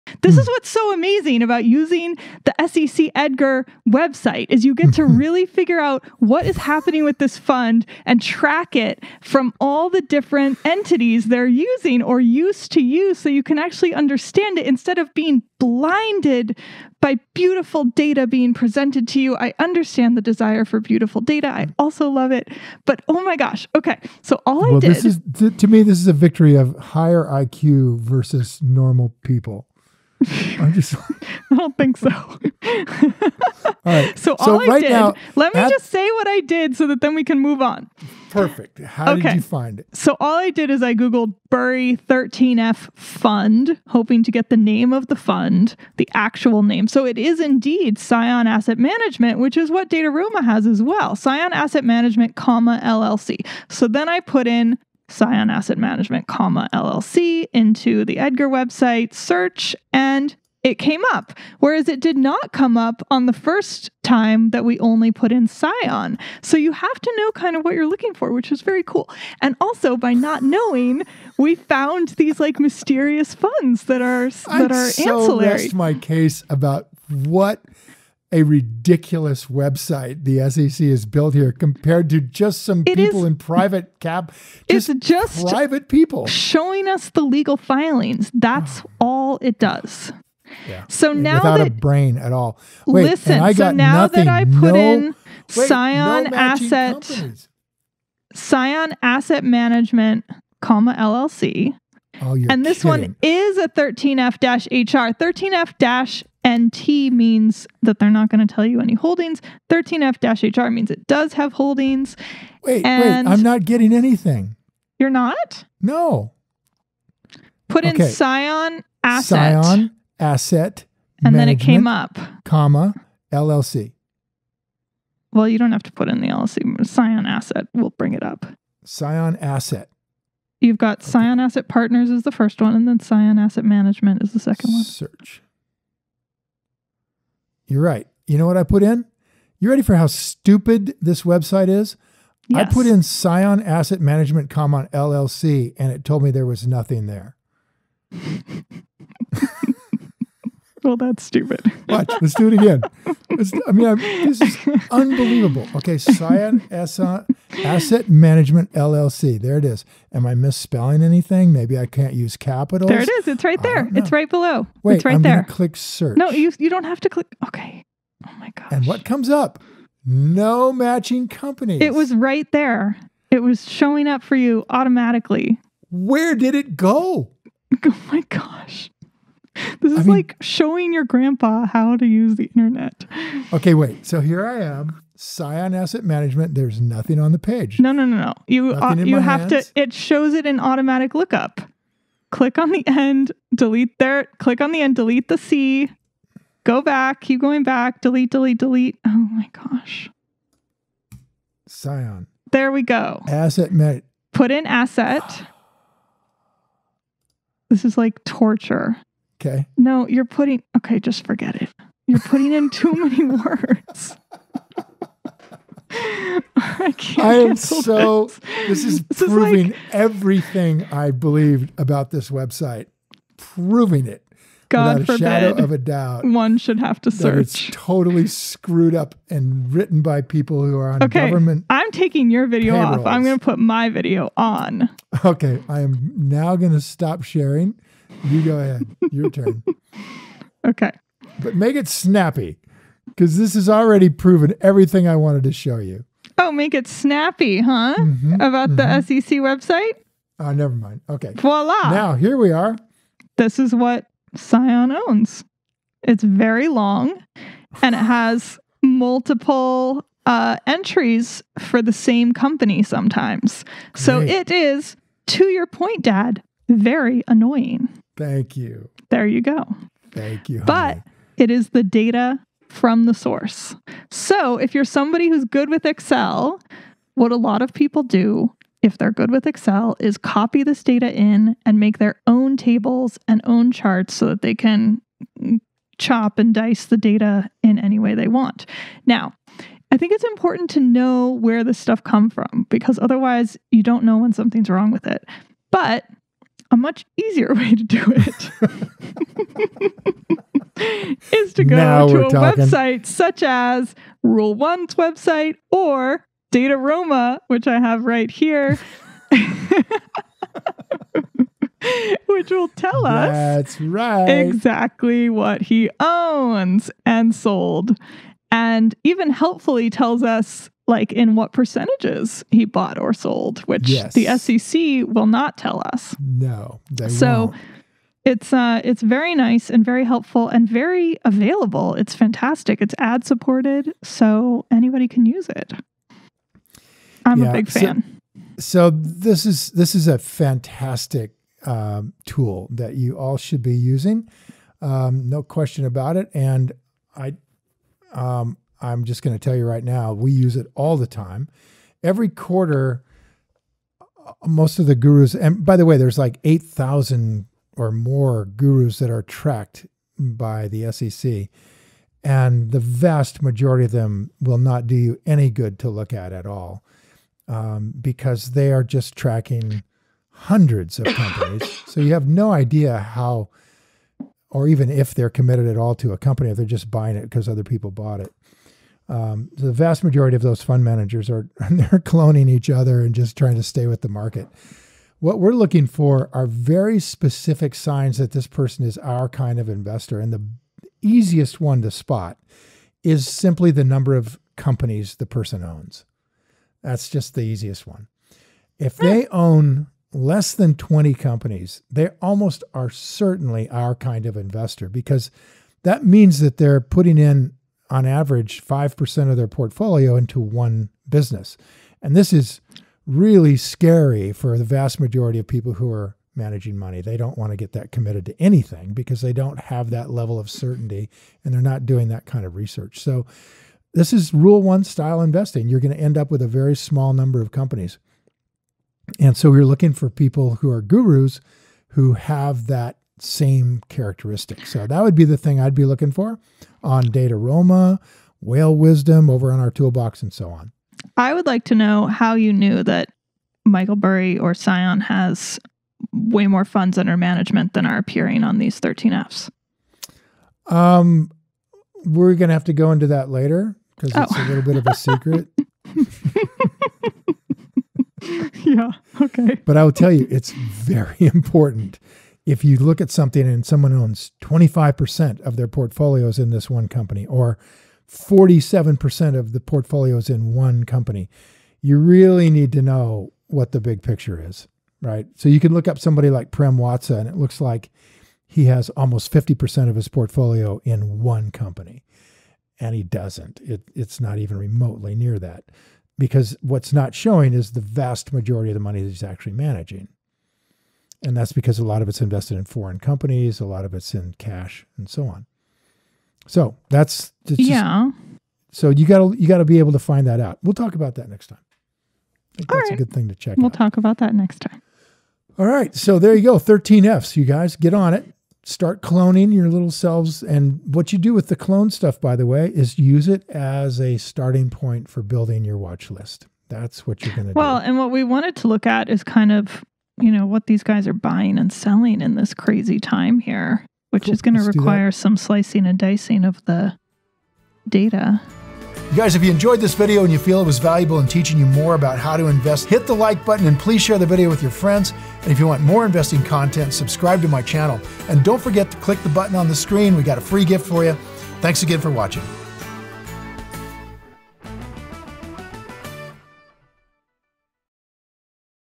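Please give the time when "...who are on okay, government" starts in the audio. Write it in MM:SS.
03:50.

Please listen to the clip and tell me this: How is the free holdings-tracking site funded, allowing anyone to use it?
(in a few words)
Ad supported.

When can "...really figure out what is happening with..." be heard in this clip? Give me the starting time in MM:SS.
00:05.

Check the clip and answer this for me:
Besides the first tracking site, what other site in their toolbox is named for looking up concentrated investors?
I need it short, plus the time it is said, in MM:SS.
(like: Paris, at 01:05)
Whale Wisdom, at 07:18.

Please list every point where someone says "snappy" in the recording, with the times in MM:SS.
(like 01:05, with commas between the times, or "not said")
04:01, 04:06.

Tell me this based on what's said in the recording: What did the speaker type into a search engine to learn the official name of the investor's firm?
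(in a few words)
Burry 13F Fund.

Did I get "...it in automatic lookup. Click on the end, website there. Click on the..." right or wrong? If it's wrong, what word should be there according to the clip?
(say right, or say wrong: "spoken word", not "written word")
wrong: "delete", not "website".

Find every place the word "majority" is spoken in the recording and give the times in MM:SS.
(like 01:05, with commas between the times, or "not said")
06:03, 06:20, 06:54, 08:08.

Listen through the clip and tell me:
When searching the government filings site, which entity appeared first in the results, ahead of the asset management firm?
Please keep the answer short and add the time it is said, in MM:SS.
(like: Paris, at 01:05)
Scion Asset Partners, at 02:11.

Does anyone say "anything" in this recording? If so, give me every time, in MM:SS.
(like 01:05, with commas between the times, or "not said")
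01:53, 02:41, 06:58.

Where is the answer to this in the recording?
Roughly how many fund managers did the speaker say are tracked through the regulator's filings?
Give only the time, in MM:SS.
05:56.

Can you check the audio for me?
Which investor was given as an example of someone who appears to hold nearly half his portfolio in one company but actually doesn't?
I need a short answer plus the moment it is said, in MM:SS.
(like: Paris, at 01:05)
Prem Watsa, at 07:56.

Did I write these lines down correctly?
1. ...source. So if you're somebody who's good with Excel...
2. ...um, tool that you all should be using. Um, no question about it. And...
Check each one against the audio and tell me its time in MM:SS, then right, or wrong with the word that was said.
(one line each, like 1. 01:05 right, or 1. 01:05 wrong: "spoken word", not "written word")
1. 04:33 right
2. 05:41 right.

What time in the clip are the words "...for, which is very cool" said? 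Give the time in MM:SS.
01:08.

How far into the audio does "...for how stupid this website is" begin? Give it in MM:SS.
02:19.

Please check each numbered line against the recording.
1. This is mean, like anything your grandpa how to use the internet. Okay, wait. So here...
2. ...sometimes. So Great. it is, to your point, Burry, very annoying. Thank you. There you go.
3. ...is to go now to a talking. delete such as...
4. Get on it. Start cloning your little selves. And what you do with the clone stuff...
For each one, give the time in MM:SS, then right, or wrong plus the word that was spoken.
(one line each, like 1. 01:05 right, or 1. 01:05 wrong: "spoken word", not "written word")
1. 02:59 wrong: "showing", not "anything"
2. 04:22 wrong: "Dad", not "Burry"
3. 05:01 wrong: "website", not "delete"
4. 08:27 right.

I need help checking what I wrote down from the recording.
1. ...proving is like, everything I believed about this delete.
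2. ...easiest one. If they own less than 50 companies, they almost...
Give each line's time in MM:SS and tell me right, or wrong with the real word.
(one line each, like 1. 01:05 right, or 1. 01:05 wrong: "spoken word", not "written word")
1. 03:39 wrong: "website", not "delete"
2. 06:37 wrong: "20", not "50".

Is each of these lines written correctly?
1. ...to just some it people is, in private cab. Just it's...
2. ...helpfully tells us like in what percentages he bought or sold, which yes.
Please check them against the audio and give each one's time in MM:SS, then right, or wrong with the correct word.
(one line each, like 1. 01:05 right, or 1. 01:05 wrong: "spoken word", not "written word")
1. 01:22 right
2. 05:19 right.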